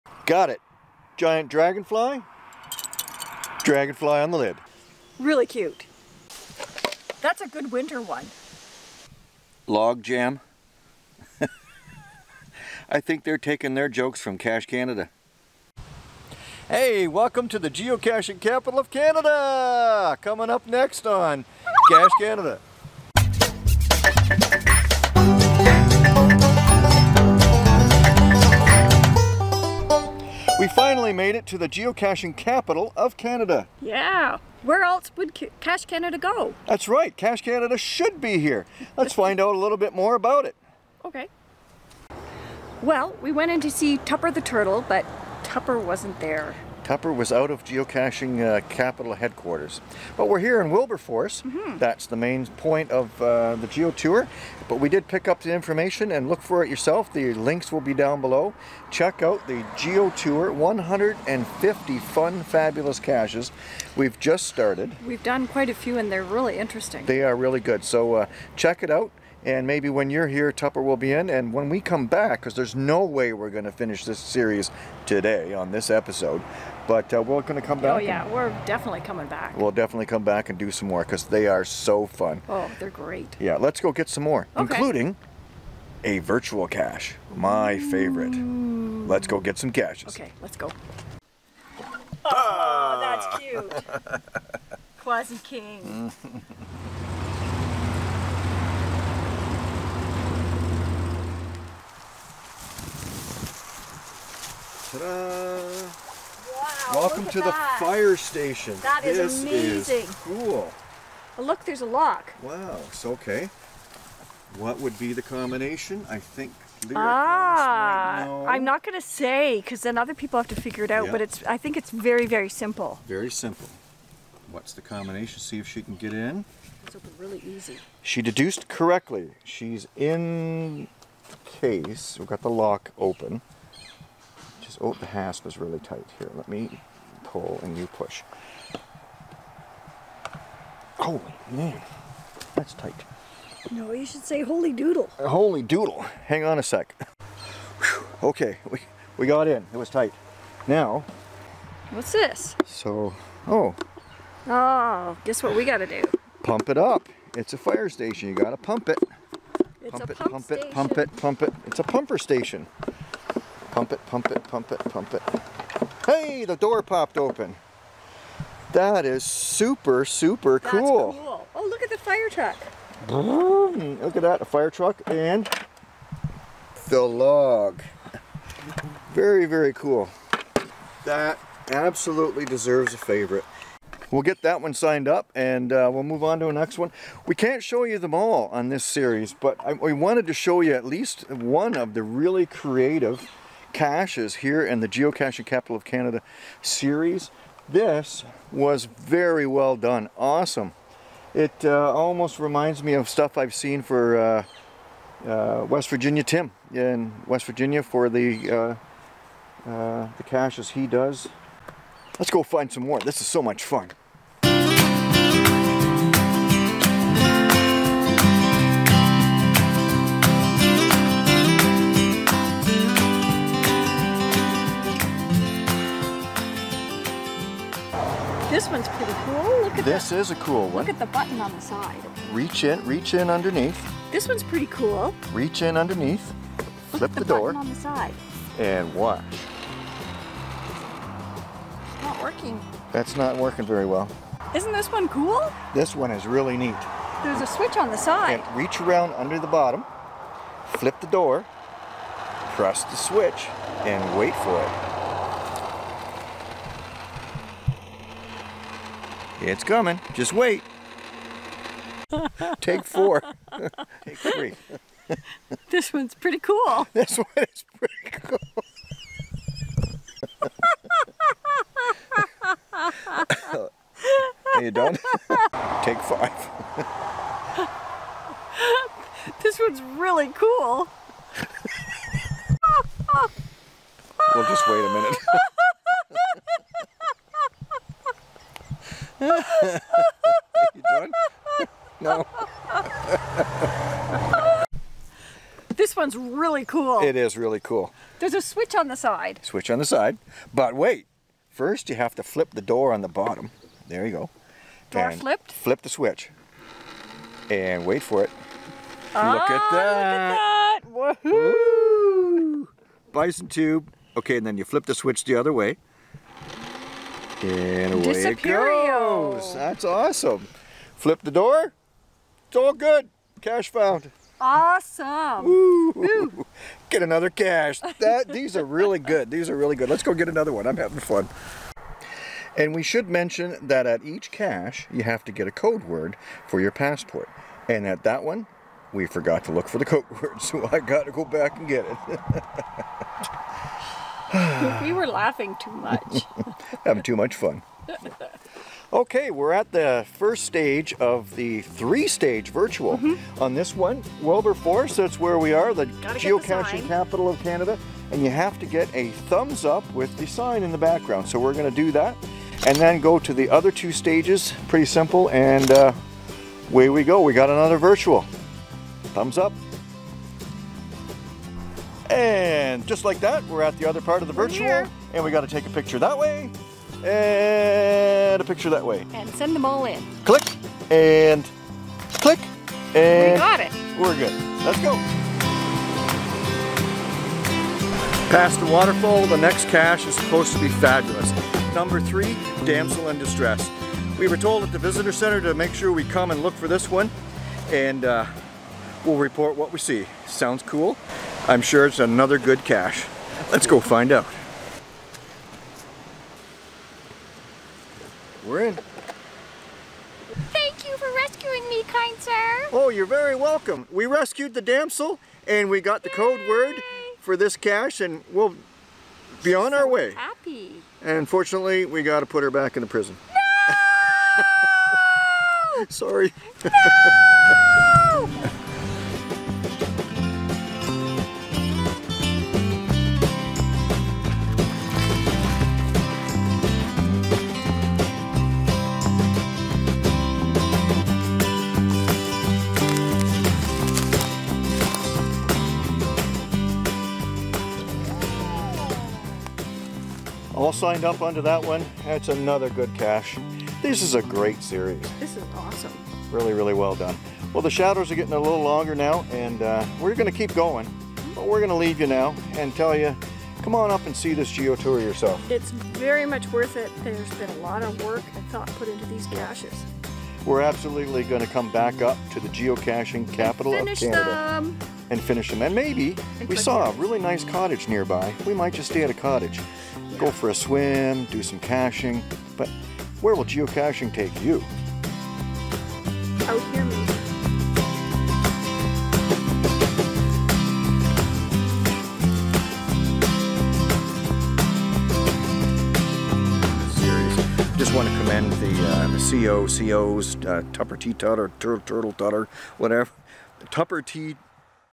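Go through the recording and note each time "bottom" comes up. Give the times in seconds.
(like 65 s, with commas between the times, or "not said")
249 s, 303 s.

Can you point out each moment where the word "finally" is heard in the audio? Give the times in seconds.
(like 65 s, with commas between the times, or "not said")
30 s.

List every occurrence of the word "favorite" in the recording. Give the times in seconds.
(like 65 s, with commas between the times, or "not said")
87 s, 182 s.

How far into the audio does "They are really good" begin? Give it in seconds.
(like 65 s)
67 s.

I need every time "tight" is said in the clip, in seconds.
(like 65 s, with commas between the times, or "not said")
135 s, 142 s, 149 s.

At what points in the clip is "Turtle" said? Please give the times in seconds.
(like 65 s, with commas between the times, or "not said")
44 s, 501 s.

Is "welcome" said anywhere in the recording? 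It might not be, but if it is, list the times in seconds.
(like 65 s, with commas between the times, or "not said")
17 s, 106 s, 413 s.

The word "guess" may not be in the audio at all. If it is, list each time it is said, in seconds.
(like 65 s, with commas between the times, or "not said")
155 s.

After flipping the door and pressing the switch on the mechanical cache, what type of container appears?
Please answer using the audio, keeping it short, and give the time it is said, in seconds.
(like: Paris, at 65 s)
Bison tube, at 313 s.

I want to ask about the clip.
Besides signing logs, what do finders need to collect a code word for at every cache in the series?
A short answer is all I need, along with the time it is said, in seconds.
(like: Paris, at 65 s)
Passport, at 336 s.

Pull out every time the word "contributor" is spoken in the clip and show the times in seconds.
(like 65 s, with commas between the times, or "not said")
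not said.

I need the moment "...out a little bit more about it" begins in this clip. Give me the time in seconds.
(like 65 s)
39 s.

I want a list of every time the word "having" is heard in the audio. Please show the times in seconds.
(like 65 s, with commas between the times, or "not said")
330 s, 346 s.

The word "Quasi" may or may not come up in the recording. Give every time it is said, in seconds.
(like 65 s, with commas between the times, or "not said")
94 s.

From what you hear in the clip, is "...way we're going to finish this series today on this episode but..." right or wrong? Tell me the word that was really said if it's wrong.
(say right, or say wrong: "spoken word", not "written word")
right.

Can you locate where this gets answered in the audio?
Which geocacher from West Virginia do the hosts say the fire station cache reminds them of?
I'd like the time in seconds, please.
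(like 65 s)
205 s.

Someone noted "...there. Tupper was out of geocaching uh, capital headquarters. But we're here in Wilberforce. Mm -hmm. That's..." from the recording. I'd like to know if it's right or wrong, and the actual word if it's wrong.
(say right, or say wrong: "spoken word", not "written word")
right.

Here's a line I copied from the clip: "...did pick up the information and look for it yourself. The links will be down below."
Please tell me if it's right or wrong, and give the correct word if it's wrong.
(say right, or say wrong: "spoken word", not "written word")
right.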